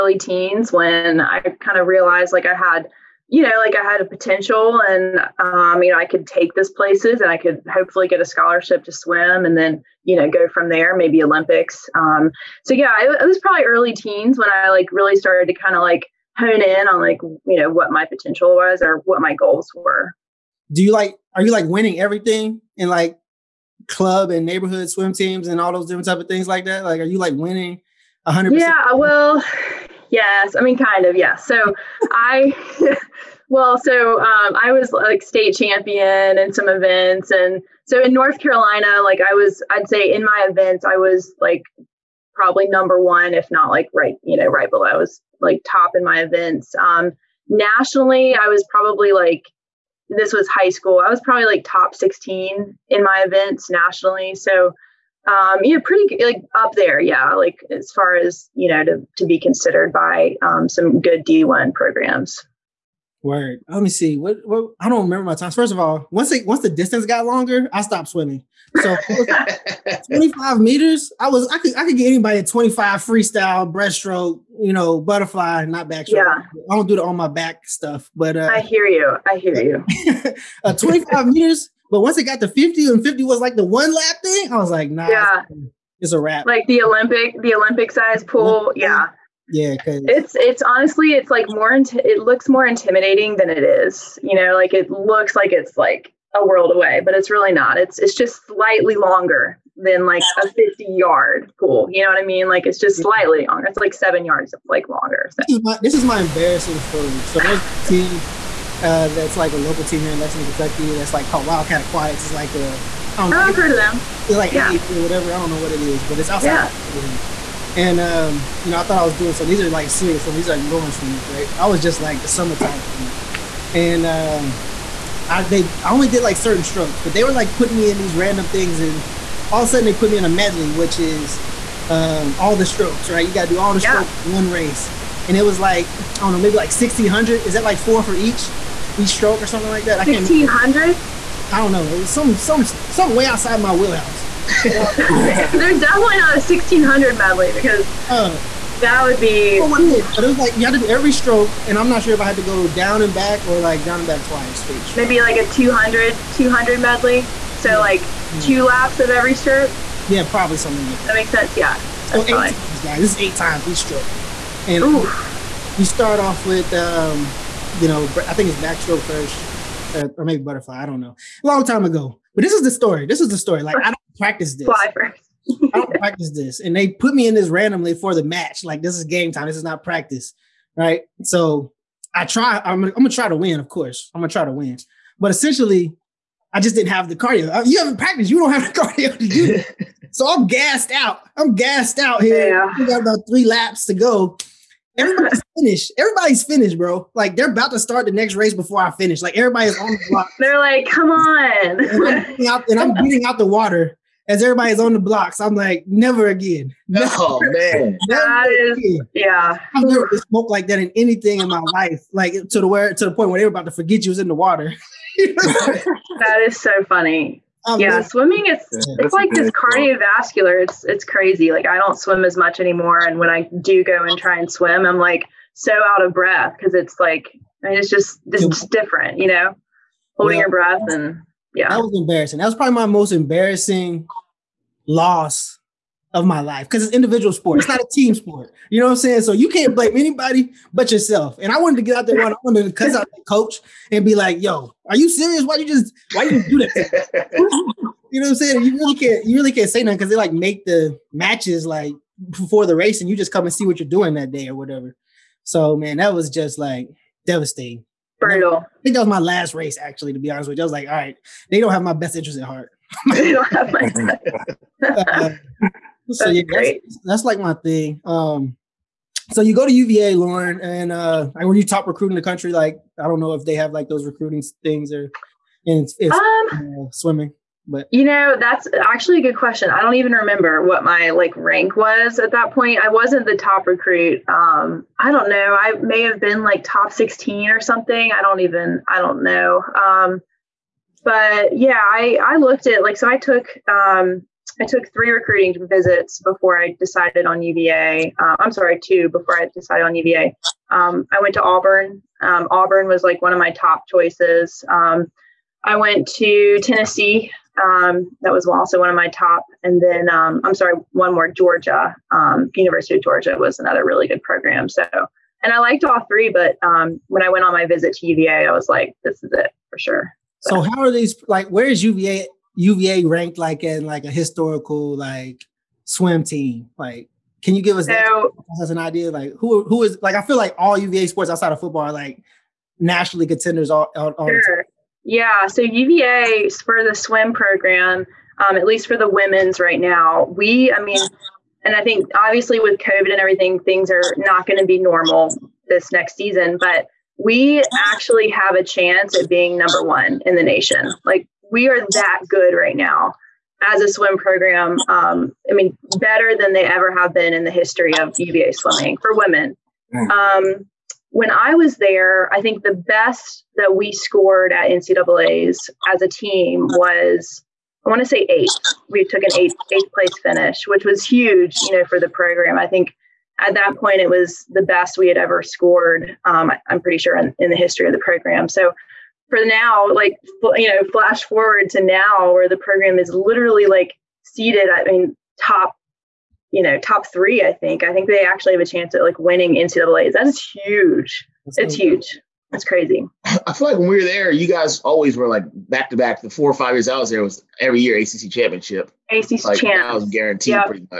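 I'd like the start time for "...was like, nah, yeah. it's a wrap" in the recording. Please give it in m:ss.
1:24.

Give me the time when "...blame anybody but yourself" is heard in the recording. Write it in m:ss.
3:59.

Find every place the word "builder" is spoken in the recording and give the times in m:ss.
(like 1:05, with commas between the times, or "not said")
not said.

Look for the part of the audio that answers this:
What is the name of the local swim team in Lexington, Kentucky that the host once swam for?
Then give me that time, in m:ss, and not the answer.
1:51.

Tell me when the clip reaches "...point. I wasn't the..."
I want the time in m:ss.
4:42.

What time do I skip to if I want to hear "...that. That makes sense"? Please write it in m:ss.
2:41.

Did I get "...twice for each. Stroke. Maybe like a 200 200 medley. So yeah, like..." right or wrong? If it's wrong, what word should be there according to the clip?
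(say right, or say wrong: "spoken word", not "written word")
right.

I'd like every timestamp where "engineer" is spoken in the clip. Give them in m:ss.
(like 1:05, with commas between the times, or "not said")
not said.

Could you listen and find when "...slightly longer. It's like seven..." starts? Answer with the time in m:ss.
1:43.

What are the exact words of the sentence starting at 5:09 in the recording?
And then um, I'm sorry, one more Georgia, um, University of Georgia was another really good program.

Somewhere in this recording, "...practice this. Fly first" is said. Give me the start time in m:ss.
2:54.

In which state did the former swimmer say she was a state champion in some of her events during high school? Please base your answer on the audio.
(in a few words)
North Carolina.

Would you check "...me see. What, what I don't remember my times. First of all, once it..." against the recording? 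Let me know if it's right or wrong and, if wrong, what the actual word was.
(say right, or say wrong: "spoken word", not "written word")
right.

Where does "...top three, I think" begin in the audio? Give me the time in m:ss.
6:26.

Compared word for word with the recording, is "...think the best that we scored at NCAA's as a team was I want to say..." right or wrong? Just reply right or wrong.
right.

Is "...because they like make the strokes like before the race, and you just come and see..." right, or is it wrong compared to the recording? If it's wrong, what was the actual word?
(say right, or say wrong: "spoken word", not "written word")
wrong: "matches", not "strokes".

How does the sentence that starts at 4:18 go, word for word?
I think that was my last race, actually, to be honest with you.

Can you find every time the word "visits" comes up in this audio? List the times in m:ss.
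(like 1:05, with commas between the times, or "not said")
4:55, 5:17.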